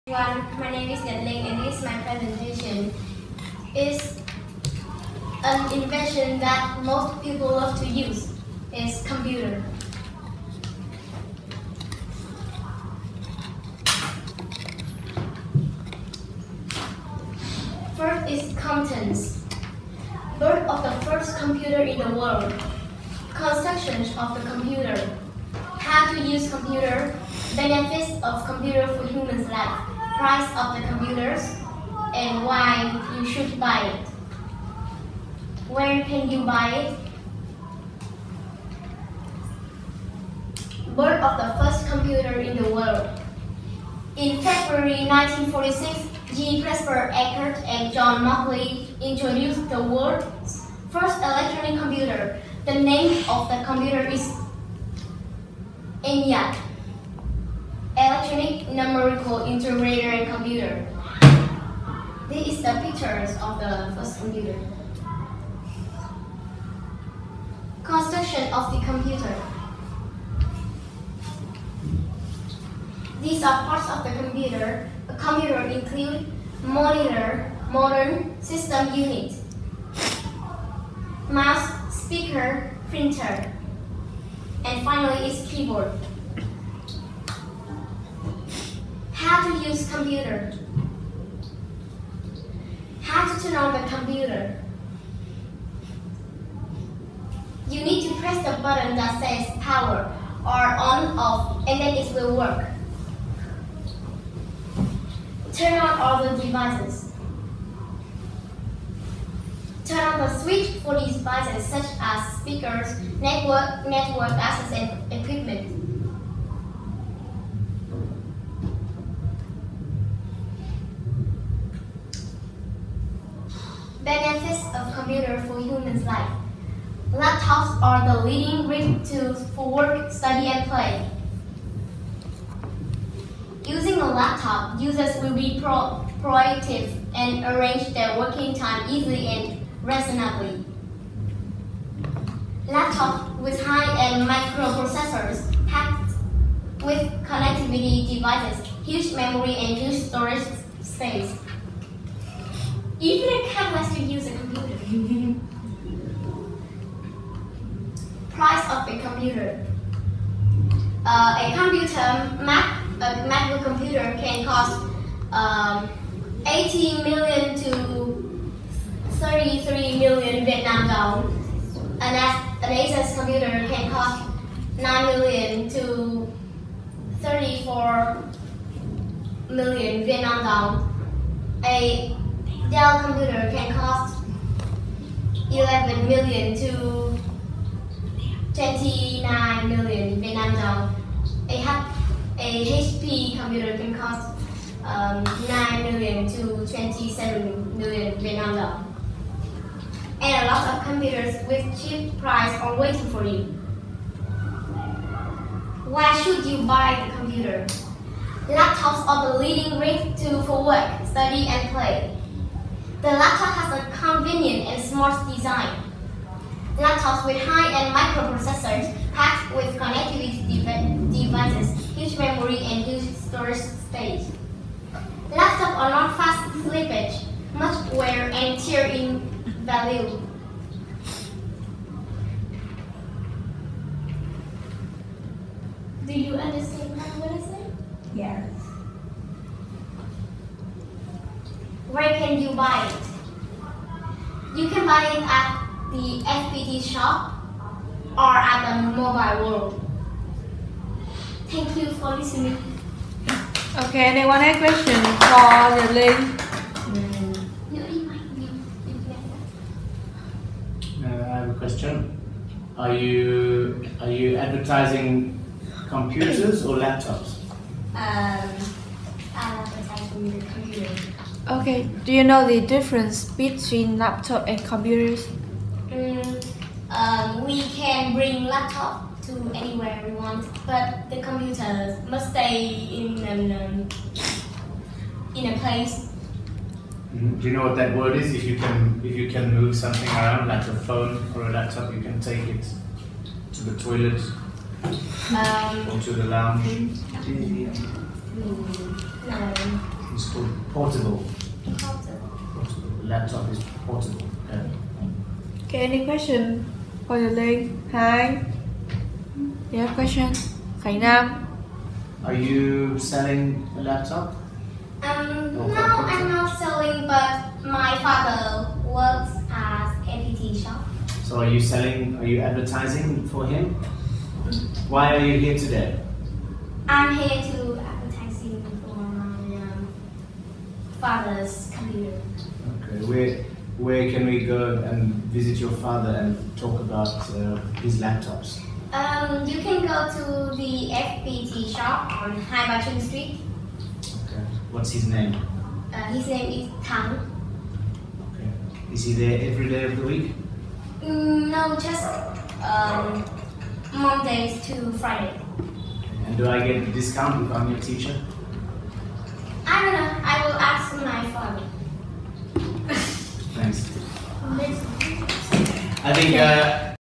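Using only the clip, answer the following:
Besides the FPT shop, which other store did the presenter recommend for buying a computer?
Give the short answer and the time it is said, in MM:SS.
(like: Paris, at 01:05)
the mobile world, at 04:08.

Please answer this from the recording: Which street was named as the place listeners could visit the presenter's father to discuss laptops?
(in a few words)
Hai Ba Street.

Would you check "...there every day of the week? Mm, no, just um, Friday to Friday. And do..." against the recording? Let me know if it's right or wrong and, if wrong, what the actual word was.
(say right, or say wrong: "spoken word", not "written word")
wrong: "Mondays", not "Friday".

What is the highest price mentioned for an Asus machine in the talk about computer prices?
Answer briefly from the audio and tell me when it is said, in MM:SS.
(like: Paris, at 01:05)
34 million Vietnam dong, at 02:57.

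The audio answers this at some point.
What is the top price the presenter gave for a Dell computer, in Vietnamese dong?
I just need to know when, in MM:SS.
03:08.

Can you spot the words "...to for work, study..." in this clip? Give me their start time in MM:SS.
03:30.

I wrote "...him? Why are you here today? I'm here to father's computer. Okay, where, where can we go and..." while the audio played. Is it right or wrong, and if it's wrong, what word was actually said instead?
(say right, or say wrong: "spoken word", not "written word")
right.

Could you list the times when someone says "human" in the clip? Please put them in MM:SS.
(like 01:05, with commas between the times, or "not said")
00:29, 02:05.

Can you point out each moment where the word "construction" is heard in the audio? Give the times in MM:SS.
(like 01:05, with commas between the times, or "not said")
00:23, 01:07.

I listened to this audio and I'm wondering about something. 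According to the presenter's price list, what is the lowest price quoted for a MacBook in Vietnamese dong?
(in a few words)
18 million.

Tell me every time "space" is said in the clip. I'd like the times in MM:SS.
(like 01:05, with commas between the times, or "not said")
02:30, 03:43.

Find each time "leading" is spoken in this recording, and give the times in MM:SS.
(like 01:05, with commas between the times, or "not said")
02:08, 03:29.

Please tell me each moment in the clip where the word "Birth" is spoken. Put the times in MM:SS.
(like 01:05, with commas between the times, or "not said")
00:20, 00:40.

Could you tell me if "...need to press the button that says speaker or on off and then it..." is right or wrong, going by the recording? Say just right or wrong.
wrong.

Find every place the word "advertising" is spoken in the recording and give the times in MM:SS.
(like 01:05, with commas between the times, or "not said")
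04:24, 04:29, 05:22.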